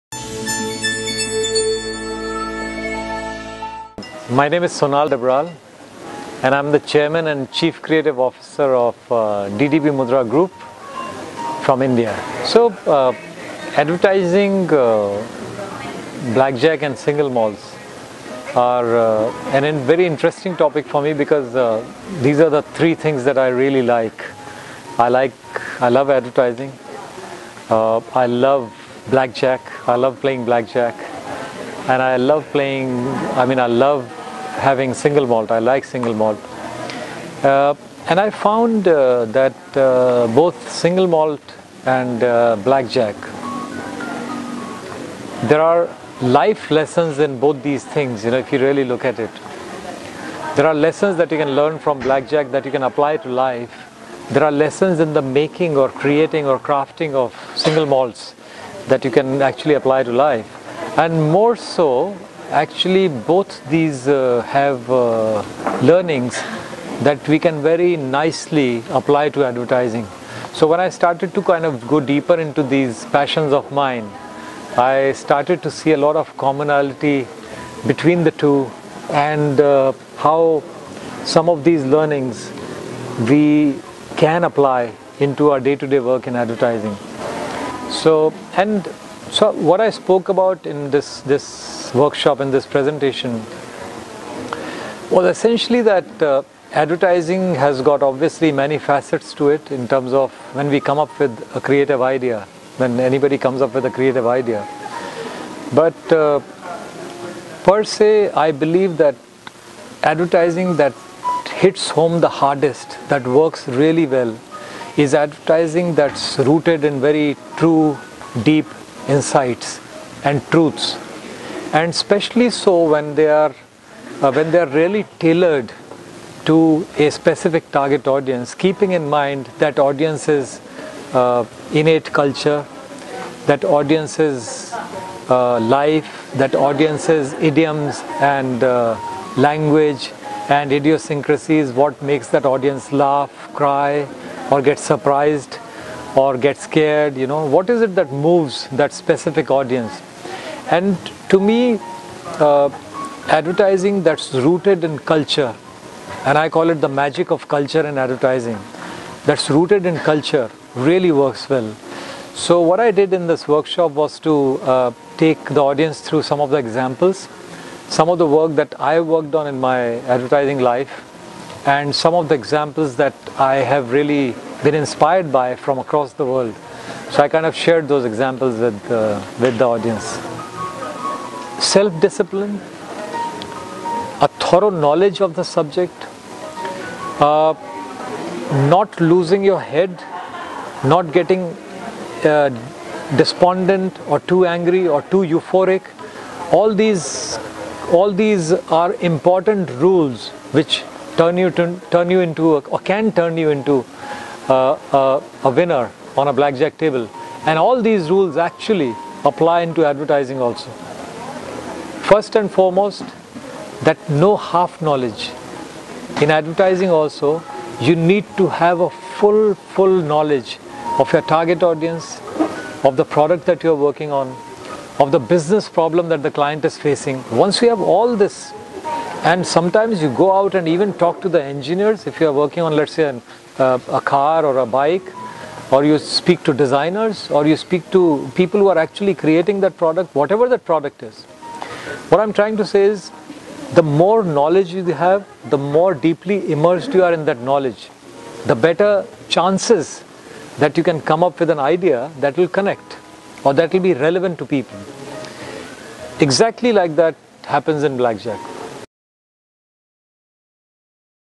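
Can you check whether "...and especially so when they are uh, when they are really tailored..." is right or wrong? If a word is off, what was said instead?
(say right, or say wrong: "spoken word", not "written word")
right.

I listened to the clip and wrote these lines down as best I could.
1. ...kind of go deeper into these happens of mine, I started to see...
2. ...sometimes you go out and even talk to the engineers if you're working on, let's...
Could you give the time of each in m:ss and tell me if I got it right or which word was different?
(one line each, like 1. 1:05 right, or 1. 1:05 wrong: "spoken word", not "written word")
1. 1:11 wrong: "passions", not "happens"
2. 3:49 right.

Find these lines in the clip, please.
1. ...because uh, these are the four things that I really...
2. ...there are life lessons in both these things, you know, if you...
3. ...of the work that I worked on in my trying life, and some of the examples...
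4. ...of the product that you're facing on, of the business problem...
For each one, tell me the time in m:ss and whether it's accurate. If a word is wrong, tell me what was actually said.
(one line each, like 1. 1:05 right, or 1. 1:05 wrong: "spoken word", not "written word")
1. 0:21 wrong: "three", not "four"
2. 0:45 right
3. 2:48 wrong: "advertising", not "trying"
4. 3:42 wrong: "working", not "facing".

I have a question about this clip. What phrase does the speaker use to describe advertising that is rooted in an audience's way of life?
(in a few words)
magic of culture.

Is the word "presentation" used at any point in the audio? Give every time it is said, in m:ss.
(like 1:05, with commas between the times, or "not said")
1:32.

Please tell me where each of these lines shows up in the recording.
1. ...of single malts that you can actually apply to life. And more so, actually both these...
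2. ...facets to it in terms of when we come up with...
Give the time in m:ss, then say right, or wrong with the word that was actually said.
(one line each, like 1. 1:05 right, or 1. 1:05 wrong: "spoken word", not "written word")
1. 0:57 right
2. 1:38 right.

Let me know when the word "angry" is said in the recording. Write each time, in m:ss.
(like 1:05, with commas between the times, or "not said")
3:14.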